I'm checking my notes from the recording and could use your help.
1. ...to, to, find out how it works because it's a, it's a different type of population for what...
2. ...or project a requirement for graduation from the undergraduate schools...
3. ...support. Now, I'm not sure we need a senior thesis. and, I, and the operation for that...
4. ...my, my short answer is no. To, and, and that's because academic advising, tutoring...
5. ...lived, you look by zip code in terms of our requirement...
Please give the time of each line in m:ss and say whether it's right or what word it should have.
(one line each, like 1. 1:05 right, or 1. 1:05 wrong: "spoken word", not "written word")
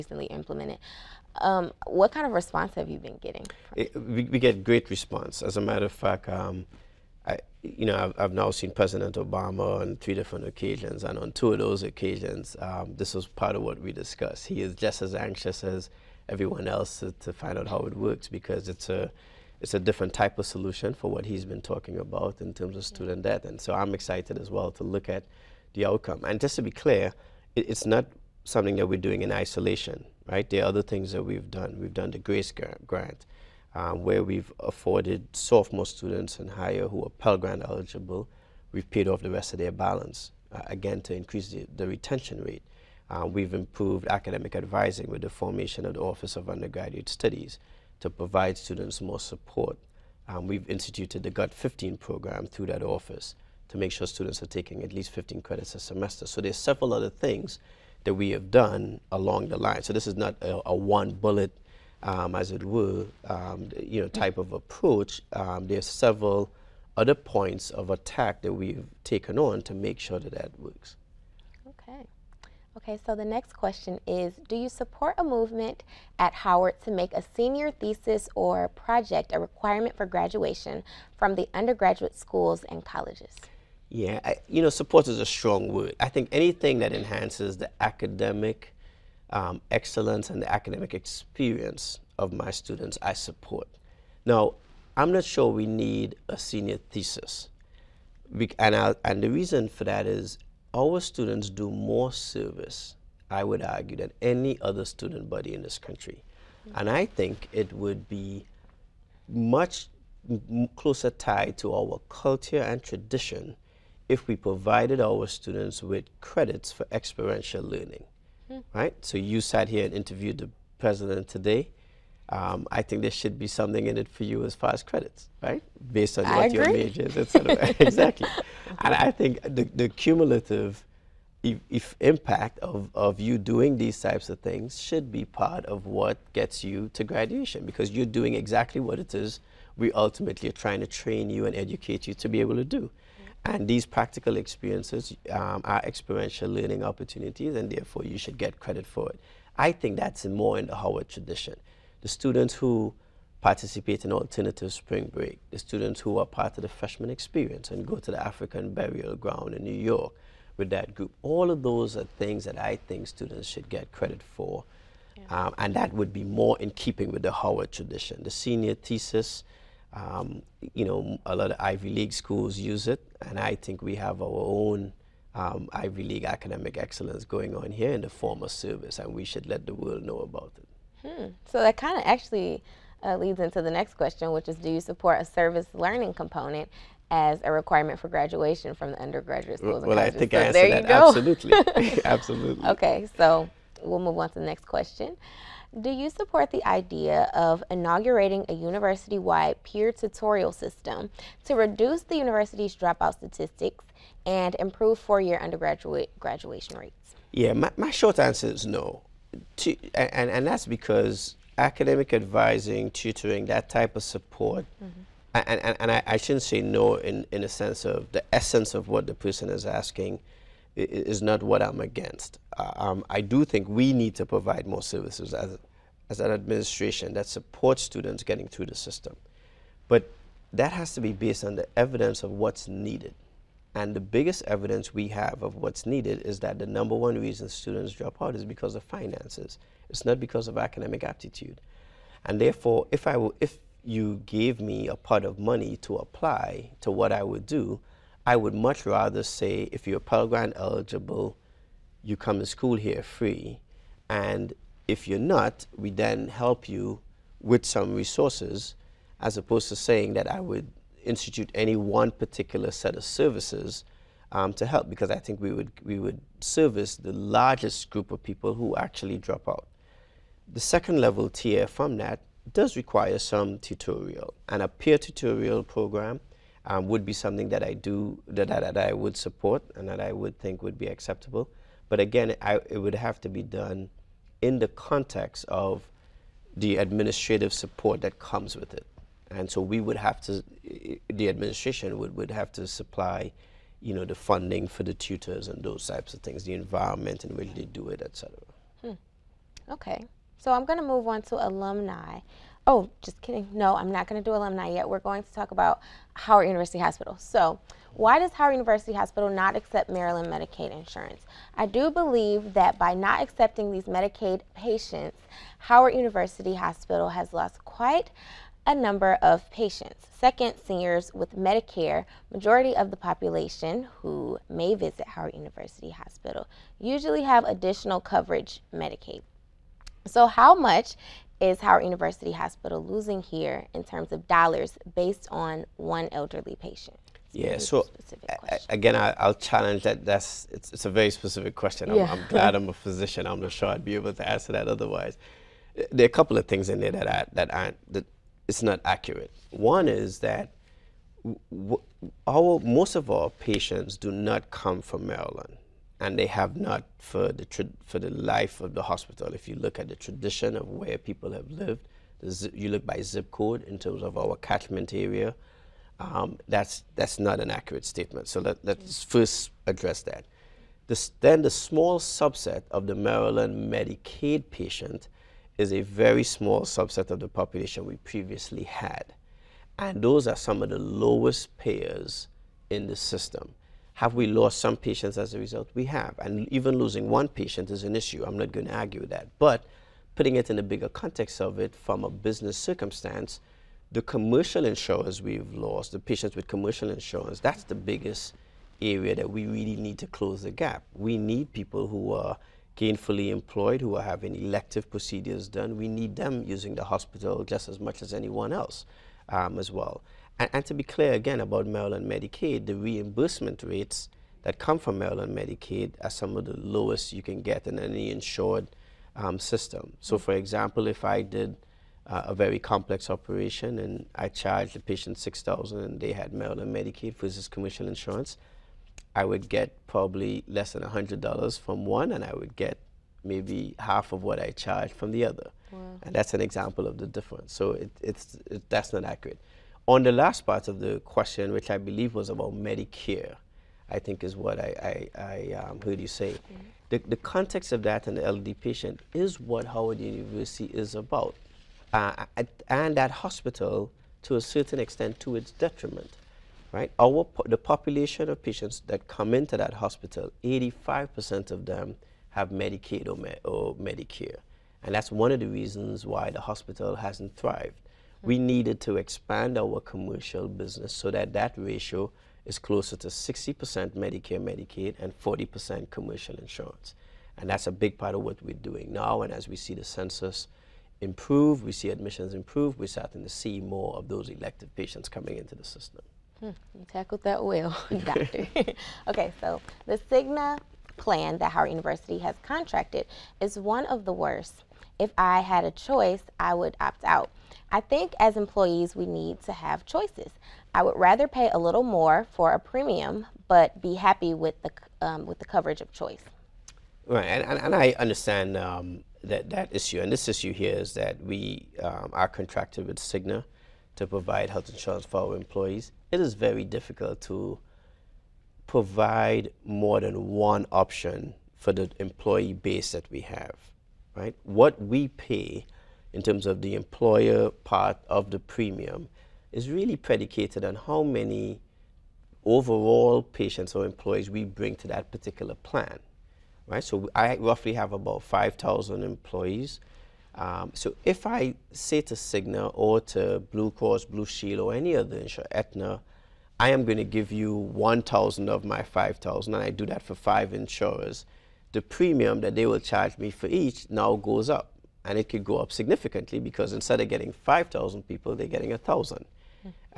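1. 0:17 wrong: "solution", not "population"
2. 1:18 right
3. 1:33 wrong: "reason", not "operation"
4. 3:27 right
5. 6:01 wrong: "catchment", not "requirement".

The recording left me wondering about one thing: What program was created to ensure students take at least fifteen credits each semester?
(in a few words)
GUT 15.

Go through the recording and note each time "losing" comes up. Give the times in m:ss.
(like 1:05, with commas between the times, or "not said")
5:32, 6:26.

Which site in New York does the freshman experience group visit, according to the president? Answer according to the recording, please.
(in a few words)
African burial ground.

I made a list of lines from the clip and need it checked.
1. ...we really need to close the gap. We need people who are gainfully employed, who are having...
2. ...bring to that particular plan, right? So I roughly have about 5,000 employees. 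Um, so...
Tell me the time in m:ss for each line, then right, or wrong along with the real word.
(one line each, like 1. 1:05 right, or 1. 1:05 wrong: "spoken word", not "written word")
1. 6:39 right
2. 8:54 right.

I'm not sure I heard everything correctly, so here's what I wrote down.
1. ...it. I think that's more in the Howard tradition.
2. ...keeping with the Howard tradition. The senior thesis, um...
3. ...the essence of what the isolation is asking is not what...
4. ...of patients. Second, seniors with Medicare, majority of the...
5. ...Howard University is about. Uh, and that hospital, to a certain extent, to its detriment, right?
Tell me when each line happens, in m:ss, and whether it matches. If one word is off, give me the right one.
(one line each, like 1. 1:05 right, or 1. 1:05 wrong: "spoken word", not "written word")
1. 2:29 right
2. 2:46 right
3. 3:38 wrong: "person", not "isolation"
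4. 5:19 right
5. 7:29 right.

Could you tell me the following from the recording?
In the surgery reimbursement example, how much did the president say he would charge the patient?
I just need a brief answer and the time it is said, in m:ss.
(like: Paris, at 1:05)
6000, at 7:05.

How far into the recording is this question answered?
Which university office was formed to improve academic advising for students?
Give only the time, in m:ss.
0:46.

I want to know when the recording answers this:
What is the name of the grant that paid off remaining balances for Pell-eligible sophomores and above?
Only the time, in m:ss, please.
0:32.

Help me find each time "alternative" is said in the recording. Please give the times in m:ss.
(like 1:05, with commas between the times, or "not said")
2:34.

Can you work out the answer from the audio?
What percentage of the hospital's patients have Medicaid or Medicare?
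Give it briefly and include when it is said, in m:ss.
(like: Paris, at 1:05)
85%, at 7:40.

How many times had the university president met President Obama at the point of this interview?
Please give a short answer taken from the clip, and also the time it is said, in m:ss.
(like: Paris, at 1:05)
3, at 0:09.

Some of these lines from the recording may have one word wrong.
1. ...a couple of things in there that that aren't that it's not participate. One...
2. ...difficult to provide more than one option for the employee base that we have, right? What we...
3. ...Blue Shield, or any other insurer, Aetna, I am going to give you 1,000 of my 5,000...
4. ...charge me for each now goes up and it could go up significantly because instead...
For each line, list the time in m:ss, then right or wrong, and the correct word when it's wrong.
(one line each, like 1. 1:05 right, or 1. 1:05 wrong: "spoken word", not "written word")
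1. 5:46 wrong: "accurate", not "participate"
2. 8:36 right
3. 9:04 right
4. 9:12 right.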